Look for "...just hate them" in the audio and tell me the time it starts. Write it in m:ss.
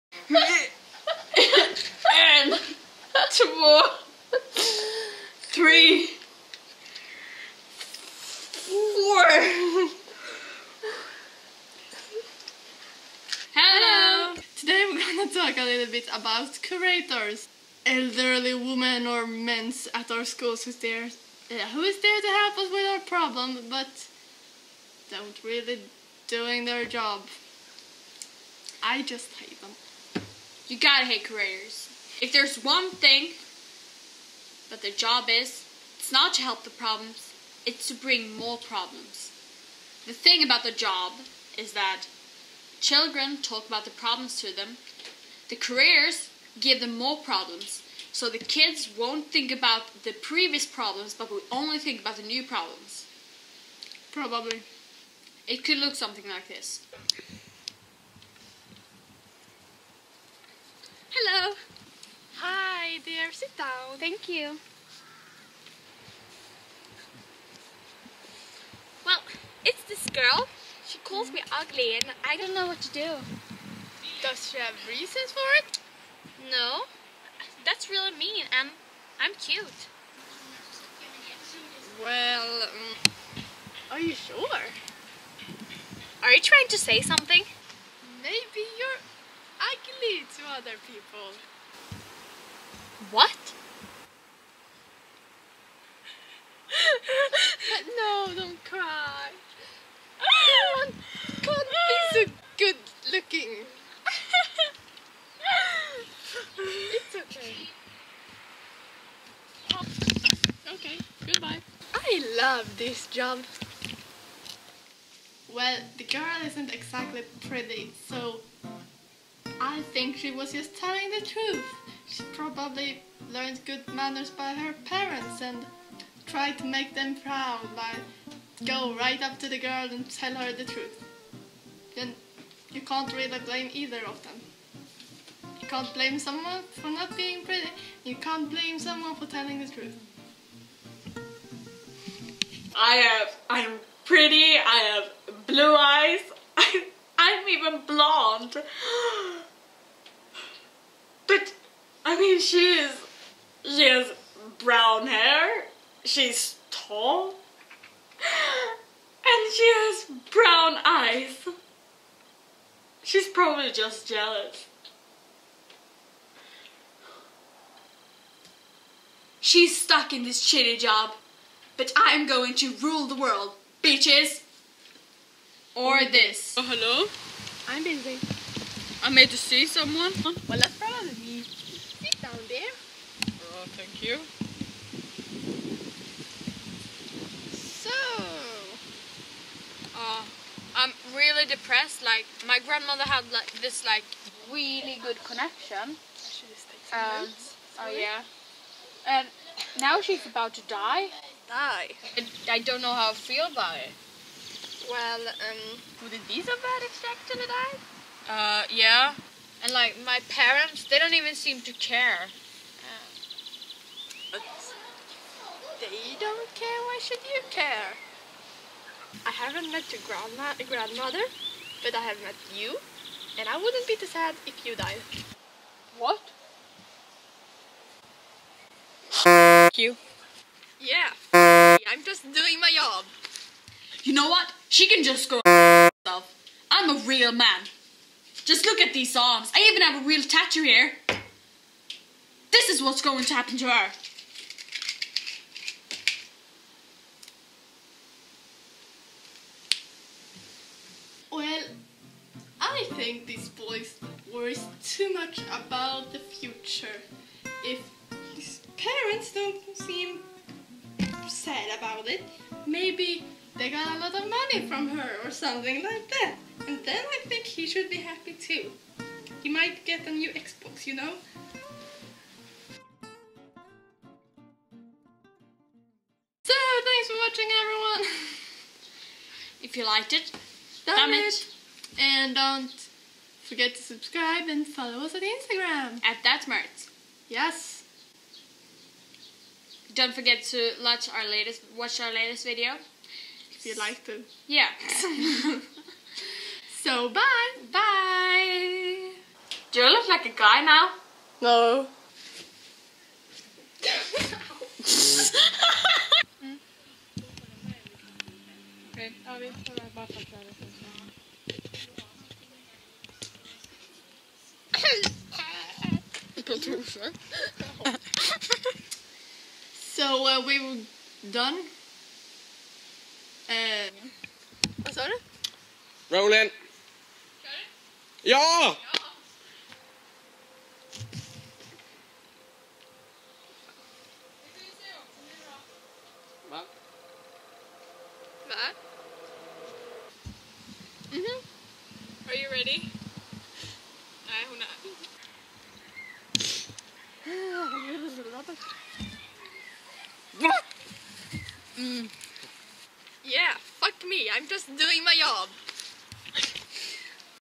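0:29.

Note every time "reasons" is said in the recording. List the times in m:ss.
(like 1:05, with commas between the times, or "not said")
1:14.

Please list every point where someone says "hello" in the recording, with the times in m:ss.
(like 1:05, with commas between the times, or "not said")
0:13, 2:56.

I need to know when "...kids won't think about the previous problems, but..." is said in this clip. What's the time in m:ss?
0:48.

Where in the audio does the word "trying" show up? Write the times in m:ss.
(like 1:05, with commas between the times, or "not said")
1:26.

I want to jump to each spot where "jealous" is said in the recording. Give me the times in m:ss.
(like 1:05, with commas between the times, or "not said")
2:44.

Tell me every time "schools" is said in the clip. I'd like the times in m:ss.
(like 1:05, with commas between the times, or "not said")
0:20.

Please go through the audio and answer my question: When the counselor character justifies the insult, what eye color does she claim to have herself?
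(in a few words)
Blue.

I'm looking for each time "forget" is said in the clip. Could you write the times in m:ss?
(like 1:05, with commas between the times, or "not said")
4:43, 4:50.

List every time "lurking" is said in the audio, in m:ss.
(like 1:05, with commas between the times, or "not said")
not said.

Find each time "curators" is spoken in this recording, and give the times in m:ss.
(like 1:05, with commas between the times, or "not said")
0:16, 0:31.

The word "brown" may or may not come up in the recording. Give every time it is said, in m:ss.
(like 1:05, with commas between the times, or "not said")
2:34, 2:40.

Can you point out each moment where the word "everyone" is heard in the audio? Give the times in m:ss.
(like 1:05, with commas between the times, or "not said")
1:40, 4:37.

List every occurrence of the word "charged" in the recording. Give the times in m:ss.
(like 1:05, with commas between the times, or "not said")
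not said.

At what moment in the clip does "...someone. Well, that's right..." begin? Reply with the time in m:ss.
2:59.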